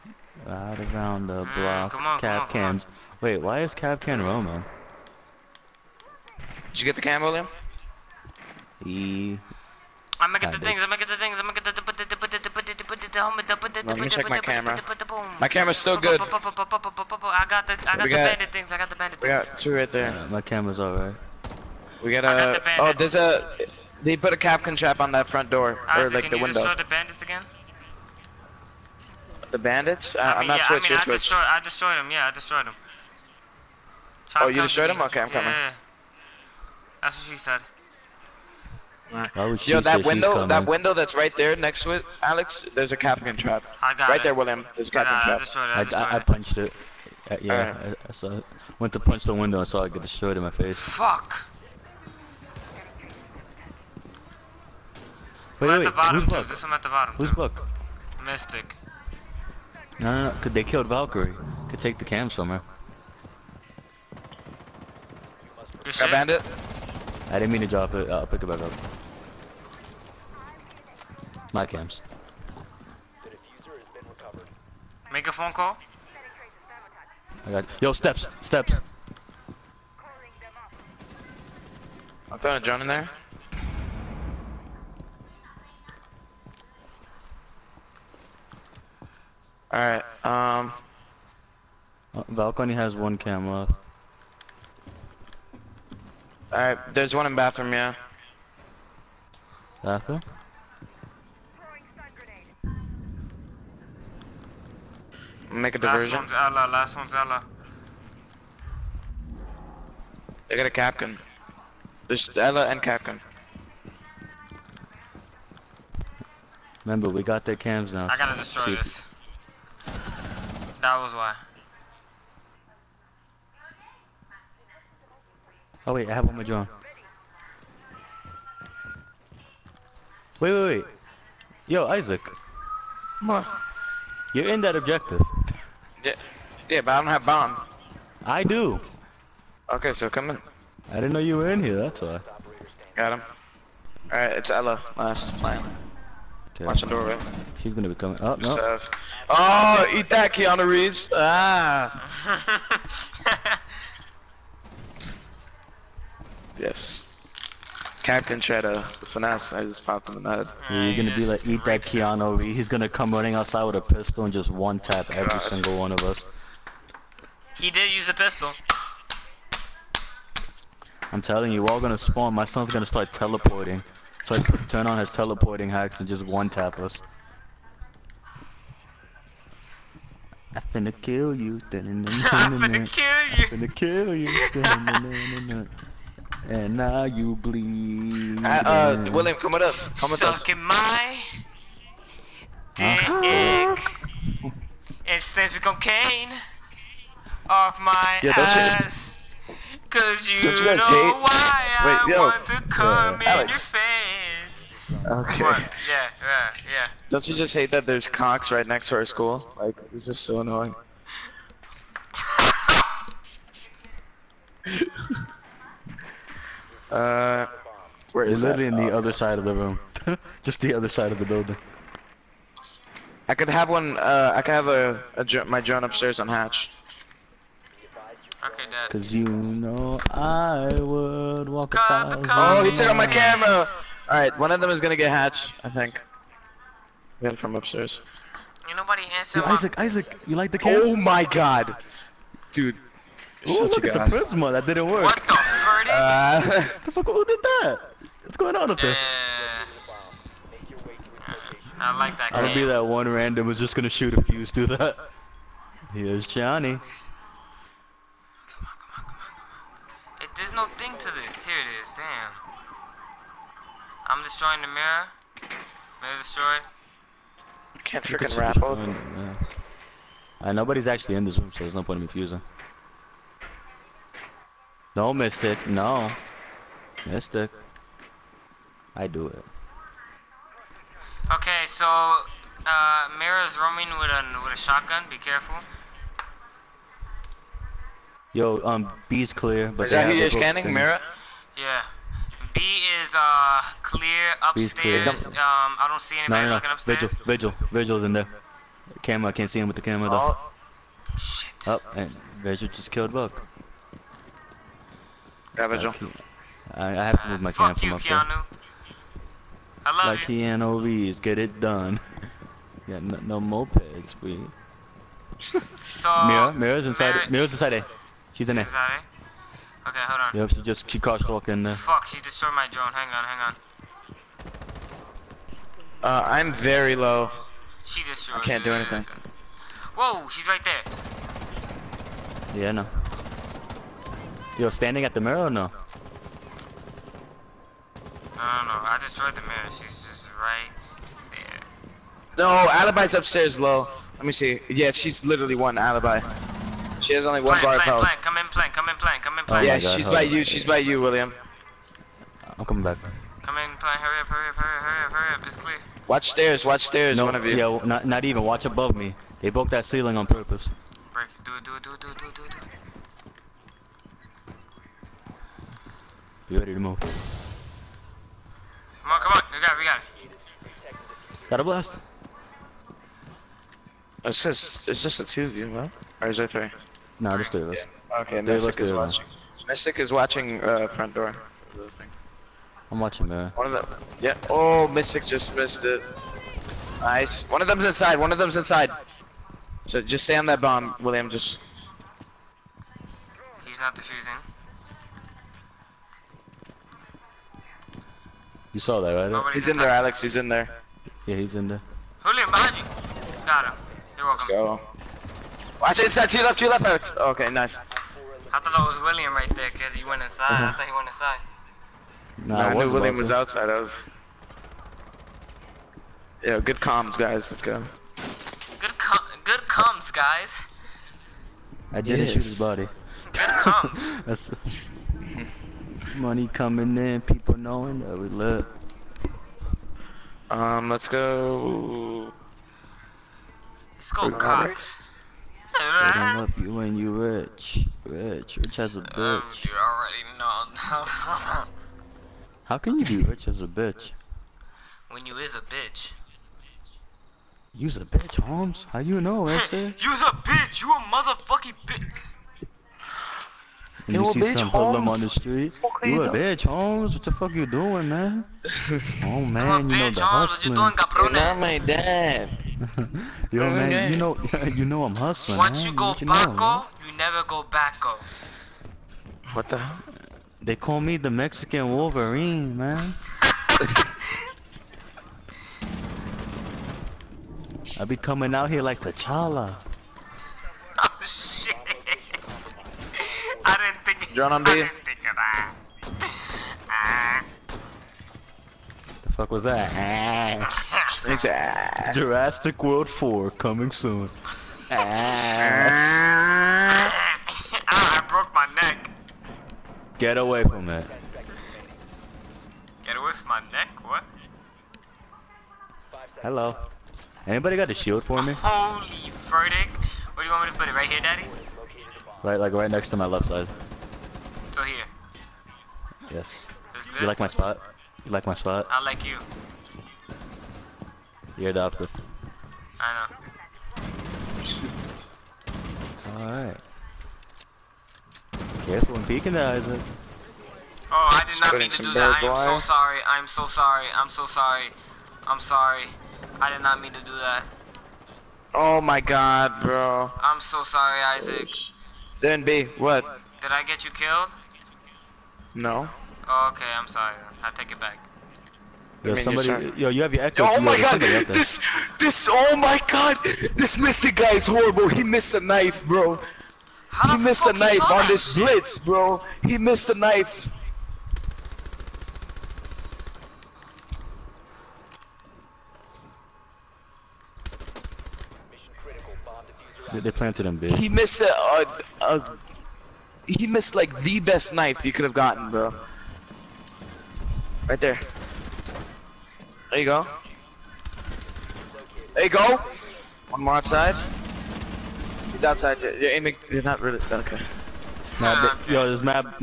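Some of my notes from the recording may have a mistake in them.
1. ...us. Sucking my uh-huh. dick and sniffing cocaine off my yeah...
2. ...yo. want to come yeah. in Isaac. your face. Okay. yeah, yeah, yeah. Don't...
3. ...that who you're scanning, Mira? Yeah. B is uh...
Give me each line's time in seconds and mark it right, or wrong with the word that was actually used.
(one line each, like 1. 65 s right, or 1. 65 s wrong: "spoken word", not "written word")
1. 190 s right
2. 202 s wrong: "Alex", not "Isaac"
3. 289 s right.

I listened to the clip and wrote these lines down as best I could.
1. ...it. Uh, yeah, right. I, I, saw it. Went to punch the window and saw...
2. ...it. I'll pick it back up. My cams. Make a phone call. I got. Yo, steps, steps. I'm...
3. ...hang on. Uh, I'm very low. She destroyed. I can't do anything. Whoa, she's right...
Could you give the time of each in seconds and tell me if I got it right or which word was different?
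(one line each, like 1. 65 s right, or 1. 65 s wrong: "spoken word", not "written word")
1. 46 s right
2. 67 s right
3. 323 s right.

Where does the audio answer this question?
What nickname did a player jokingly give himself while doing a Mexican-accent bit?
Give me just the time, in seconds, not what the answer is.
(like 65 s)
471 s.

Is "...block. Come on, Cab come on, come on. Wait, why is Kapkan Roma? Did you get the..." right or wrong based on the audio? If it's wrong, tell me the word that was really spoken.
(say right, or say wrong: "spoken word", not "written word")
right.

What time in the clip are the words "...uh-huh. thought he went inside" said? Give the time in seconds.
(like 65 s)
410 s.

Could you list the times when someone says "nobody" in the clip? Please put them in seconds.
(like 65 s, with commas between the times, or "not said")
238 s, 270 s, 399 s.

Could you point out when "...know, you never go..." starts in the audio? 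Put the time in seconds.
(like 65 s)
466 s.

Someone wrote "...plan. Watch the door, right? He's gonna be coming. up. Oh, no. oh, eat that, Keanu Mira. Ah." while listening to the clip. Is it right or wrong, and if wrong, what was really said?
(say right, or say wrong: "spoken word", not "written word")
wrong: "Reeves", not "Mira".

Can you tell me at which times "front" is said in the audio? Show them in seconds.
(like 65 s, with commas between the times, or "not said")
25 s, 380 s.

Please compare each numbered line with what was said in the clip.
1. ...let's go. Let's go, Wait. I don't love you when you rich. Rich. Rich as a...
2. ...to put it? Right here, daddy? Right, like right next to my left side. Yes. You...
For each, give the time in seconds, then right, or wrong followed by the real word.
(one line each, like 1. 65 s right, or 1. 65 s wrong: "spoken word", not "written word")
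1. 430 s wrong: "Cox", not "Wait"
2. 510 s right.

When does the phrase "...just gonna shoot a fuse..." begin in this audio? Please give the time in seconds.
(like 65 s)
253 s.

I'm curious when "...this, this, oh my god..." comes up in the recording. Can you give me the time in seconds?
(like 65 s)
551 s.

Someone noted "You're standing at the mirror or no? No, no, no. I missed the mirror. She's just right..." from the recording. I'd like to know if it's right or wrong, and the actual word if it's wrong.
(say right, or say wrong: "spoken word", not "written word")
wrong: "destroyed", not "missed".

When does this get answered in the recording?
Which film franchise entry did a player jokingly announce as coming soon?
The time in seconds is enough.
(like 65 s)
492 s.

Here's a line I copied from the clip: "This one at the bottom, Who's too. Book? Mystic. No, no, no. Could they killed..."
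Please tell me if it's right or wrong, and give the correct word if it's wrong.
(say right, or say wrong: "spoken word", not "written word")
right.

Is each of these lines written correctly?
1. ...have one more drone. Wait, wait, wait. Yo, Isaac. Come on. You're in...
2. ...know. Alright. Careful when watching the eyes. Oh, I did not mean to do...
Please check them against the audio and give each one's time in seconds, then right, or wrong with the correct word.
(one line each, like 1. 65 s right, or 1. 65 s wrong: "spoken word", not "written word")
1. 126 s right
2. 523 s wrong: "peeking", not "watching".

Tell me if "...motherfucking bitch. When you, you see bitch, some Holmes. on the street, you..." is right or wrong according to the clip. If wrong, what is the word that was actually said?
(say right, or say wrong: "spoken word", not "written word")
right.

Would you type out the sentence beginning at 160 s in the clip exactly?
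Yeah, you're gonna be like, eat that Keanu Reeves.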